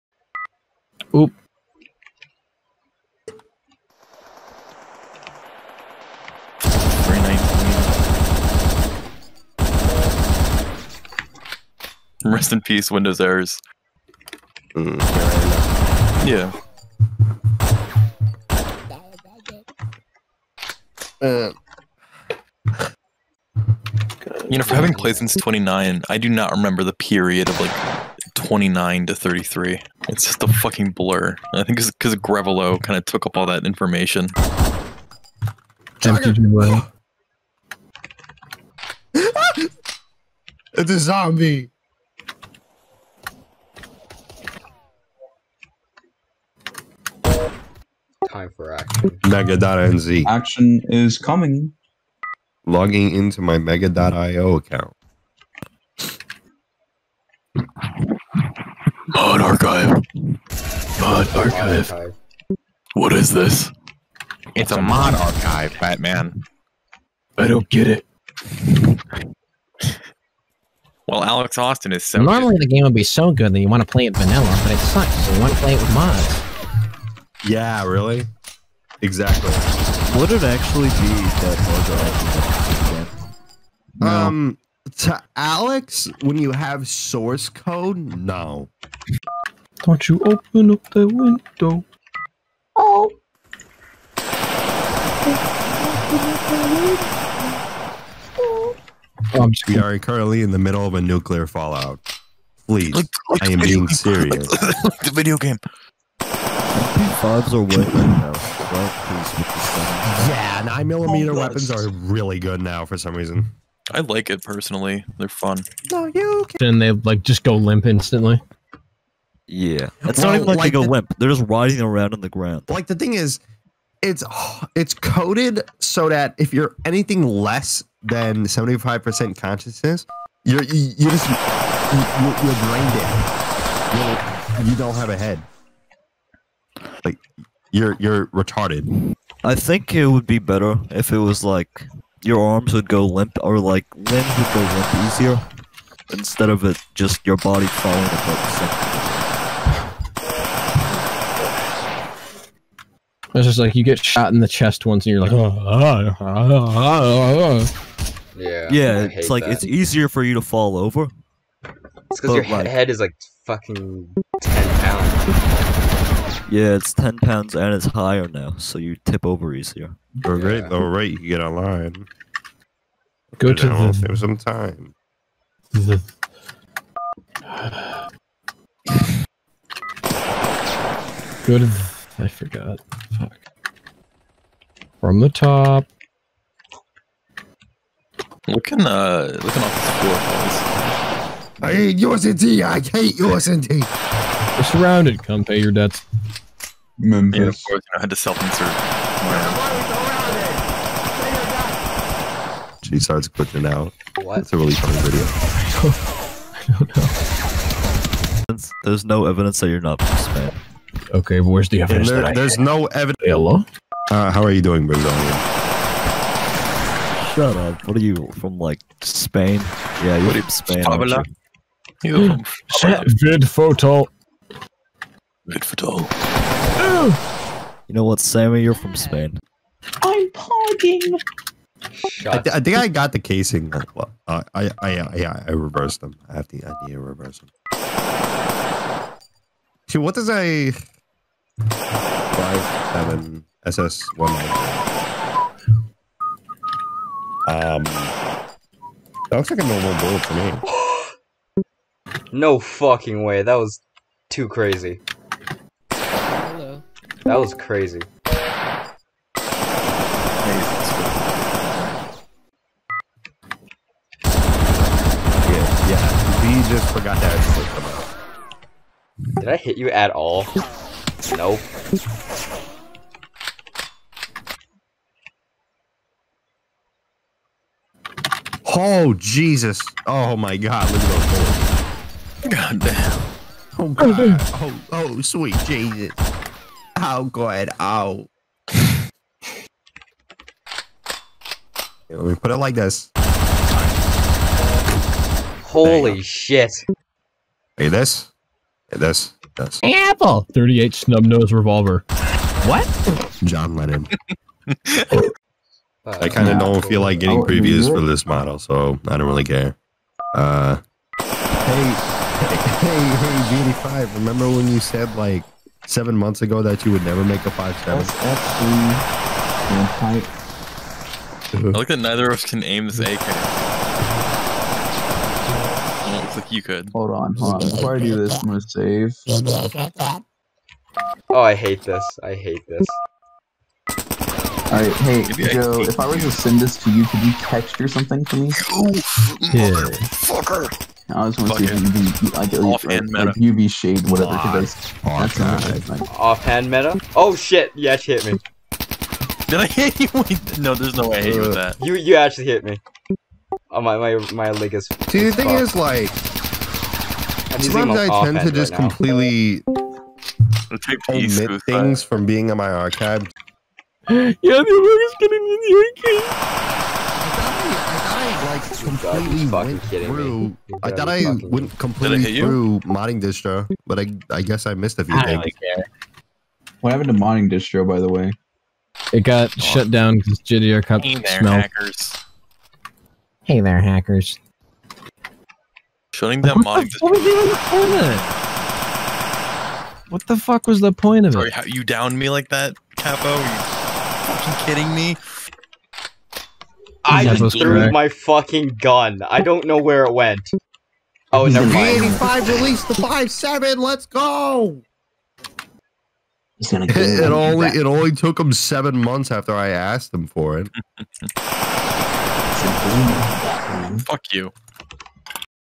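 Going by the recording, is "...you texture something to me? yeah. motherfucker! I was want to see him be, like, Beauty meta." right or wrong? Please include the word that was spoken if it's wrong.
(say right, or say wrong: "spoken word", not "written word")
wrong: "Offhand", not "Beauty".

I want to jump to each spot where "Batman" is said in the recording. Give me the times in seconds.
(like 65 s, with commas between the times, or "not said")
65 s.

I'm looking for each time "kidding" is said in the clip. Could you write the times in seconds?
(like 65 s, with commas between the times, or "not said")
394 s.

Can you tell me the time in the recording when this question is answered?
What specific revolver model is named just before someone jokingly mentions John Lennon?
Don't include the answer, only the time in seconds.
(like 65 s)
300 s.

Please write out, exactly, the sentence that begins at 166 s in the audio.
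Yeah, it's 10 pounds and it's higher now, so you tip over easier.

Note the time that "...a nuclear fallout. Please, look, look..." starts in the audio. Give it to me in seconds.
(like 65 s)
100 s.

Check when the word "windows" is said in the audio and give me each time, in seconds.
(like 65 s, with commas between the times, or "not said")
12 s, 91 s.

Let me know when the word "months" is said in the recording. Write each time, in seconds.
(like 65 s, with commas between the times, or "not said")
316 s, 408 s.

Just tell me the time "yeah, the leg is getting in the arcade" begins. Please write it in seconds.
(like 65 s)
364 s.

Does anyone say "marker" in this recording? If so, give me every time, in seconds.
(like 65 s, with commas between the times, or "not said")
not said.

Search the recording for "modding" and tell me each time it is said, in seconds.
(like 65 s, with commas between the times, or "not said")
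372 s, 377 s.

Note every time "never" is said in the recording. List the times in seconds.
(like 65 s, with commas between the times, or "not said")
317 s, 401 s.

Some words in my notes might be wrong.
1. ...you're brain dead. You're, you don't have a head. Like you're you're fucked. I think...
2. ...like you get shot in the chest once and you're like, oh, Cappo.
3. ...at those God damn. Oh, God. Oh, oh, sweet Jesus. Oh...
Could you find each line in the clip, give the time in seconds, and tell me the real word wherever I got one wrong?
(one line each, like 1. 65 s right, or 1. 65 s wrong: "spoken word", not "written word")
1. 132 s wrong: "retarded", not "fucked"
2. 153 s wrong: "Yeah", not "Cappo"
3. 281 s right.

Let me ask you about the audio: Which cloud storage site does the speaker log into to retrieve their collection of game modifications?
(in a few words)
Mega.nz.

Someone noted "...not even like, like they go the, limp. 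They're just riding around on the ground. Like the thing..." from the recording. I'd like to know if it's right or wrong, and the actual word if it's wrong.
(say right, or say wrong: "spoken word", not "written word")
right.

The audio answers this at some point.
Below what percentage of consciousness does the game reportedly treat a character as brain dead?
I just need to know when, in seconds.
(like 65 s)
128 s.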